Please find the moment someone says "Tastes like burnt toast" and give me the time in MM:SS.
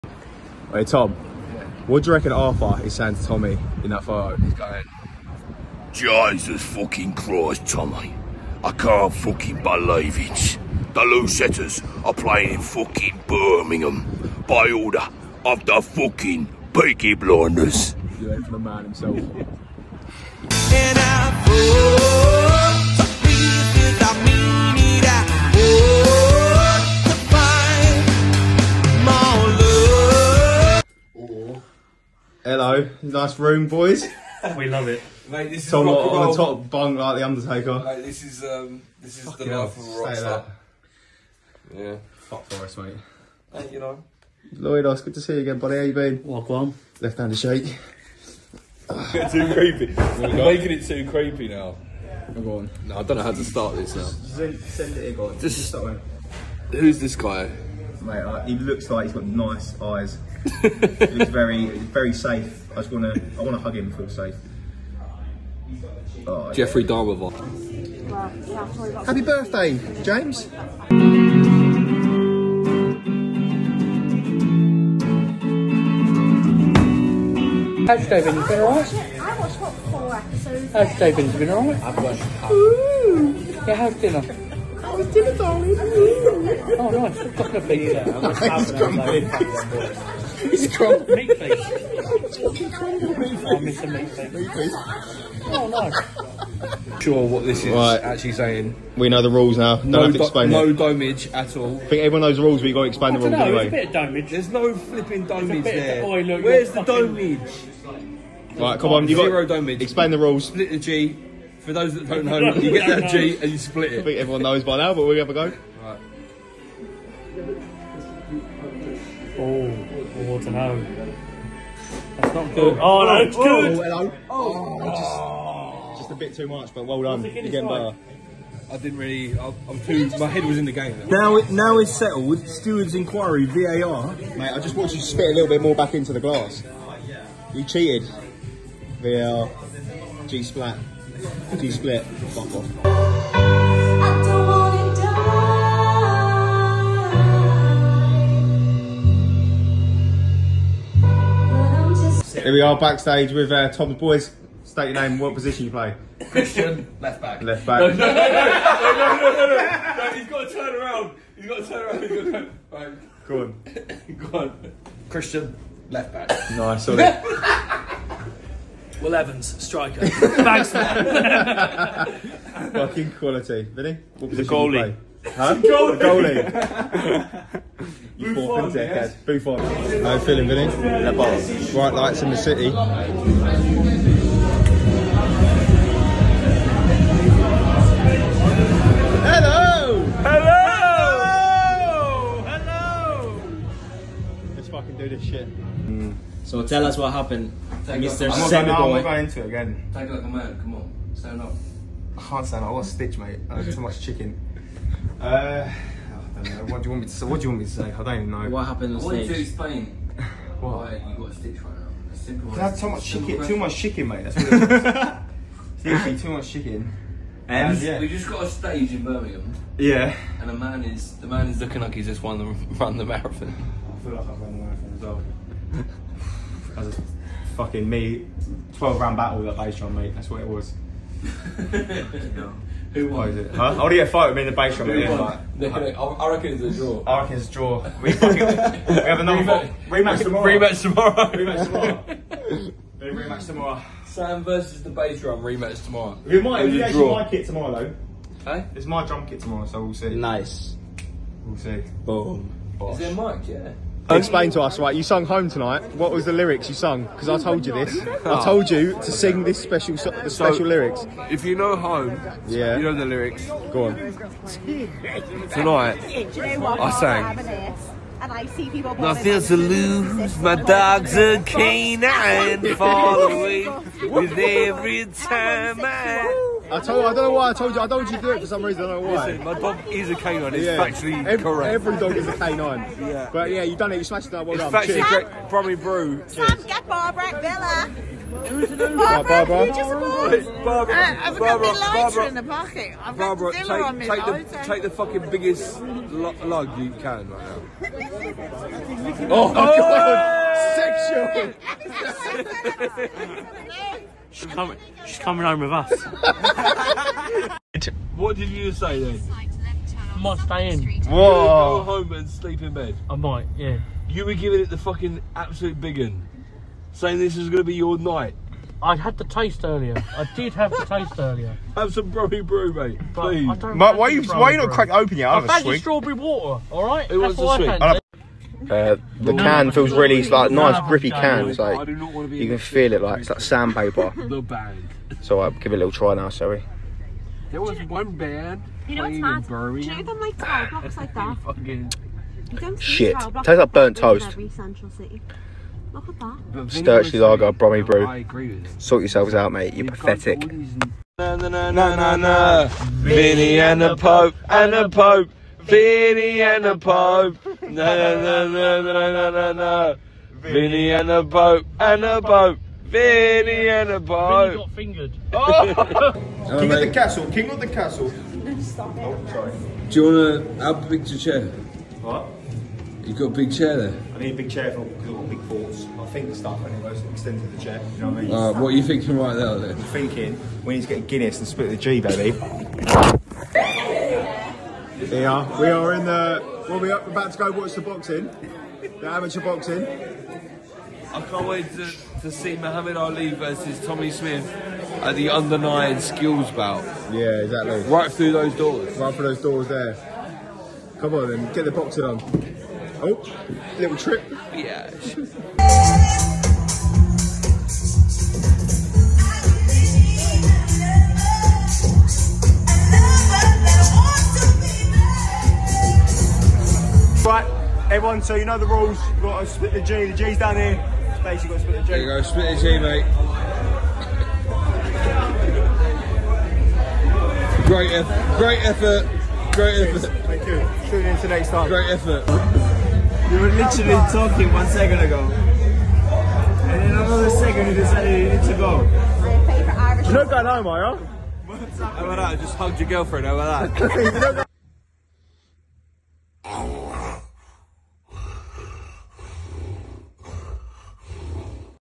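05:43.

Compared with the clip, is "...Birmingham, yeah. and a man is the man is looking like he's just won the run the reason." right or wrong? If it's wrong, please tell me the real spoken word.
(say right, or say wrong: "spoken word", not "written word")
wrong: "marathon", not "reason".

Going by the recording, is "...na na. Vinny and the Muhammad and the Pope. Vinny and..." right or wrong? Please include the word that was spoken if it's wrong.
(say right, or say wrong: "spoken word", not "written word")
wrong: "Pope", not "Muhammad".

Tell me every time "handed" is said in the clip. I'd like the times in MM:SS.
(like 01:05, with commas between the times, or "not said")
00:47.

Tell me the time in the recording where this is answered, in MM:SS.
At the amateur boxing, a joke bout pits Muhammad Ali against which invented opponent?
06:33.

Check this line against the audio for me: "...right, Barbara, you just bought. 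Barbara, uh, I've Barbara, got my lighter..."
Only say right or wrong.
right.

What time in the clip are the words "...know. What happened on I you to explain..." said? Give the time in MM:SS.
03:28.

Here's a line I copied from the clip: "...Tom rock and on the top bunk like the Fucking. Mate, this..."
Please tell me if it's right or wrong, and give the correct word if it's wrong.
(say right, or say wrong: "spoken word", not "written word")
wrong: "Undertaker", not "Fucking".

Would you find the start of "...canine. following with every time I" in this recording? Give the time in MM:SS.
04:31.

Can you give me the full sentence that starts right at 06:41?
Come on then, get the boxing on.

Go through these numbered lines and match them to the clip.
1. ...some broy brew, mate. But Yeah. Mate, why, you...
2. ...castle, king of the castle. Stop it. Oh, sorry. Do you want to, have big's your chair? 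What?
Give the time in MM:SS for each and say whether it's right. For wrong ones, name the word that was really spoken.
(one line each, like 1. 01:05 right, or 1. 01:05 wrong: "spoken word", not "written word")
1. 05:21 wrong: "Please", not "Yeah"
2. 06:06 right.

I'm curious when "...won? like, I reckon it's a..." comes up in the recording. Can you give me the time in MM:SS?
03:55.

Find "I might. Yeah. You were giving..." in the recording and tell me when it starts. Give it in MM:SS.
05:13.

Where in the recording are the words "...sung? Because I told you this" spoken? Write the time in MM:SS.
04:16.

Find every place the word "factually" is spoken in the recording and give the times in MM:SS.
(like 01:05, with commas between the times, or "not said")
04:40, 04:44.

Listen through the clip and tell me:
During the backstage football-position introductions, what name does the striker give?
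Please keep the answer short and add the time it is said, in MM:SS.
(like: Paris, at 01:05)
Will Evans, at 02:49.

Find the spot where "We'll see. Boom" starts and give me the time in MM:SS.
04:11.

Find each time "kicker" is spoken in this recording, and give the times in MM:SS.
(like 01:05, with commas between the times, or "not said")
not said.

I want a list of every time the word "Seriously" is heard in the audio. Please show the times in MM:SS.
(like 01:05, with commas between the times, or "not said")
03:35.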